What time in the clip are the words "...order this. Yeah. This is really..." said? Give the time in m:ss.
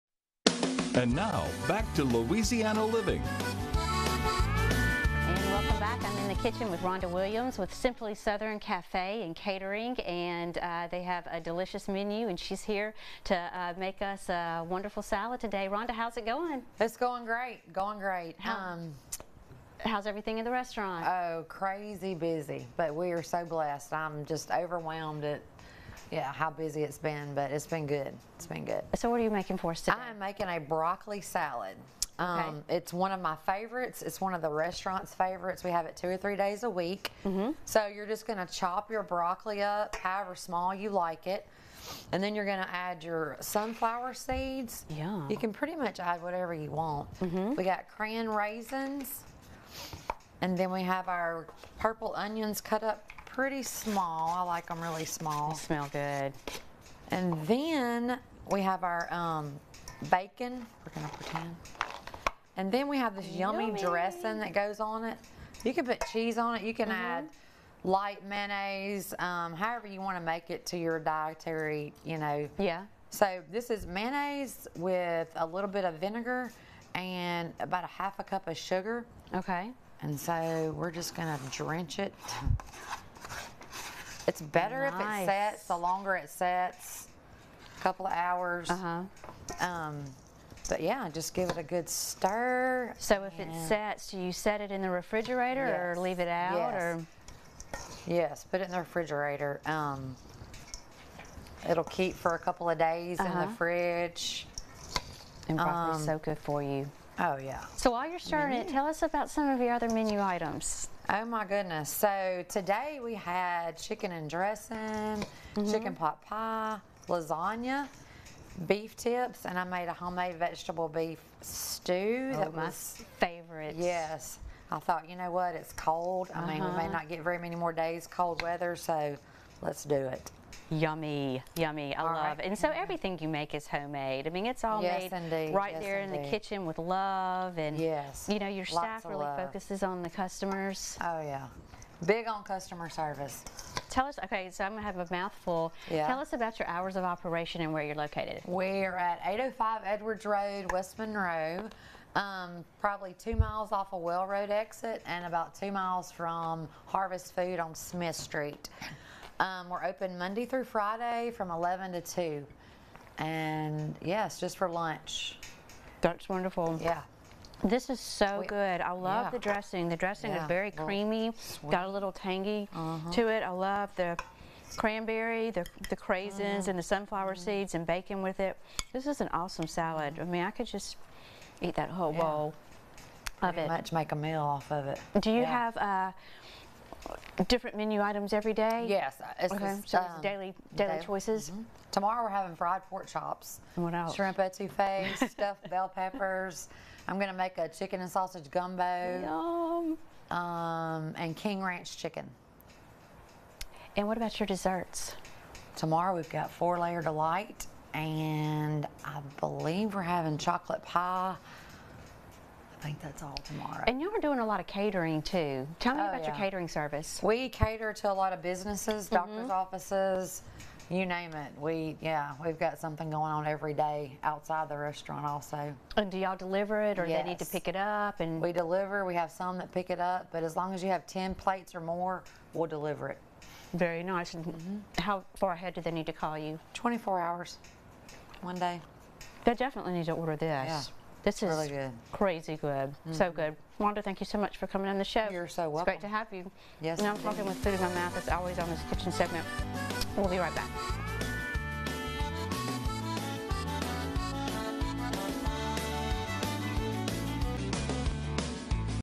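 4:00.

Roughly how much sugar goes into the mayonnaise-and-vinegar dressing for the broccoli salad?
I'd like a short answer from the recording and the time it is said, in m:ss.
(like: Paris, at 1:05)
half a cup, at 1:17.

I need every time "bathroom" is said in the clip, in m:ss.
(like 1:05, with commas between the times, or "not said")
not said.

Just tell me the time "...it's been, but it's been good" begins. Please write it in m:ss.
0:26.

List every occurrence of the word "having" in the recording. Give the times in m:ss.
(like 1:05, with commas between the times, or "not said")
3:12, 3:30.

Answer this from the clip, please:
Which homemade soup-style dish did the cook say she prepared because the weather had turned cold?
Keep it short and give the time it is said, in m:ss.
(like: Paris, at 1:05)
vegetable beef stew, at 1:59.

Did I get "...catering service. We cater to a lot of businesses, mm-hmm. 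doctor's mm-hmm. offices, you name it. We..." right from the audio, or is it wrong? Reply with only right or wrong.
right.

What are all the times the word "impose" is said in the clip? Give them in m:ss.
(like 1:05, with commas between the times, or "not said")
not said.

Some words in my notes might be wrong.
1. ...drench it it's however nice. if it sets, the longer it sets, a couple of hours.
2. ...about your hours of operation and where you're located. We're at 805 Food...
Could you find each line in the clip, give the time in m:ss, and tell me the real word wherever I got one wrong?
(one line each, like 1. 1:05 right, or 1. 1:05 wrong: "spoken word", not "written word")
1. 1:21 wrong: "better", not "however"
2. 2:26 wrong: "Edwards", not "Food".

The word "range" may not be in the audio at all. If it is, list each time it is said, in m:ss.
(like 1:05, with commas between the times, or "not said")
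not said.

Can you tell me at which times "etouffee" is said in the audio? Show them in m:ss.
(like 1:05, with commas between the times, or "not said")
3:14.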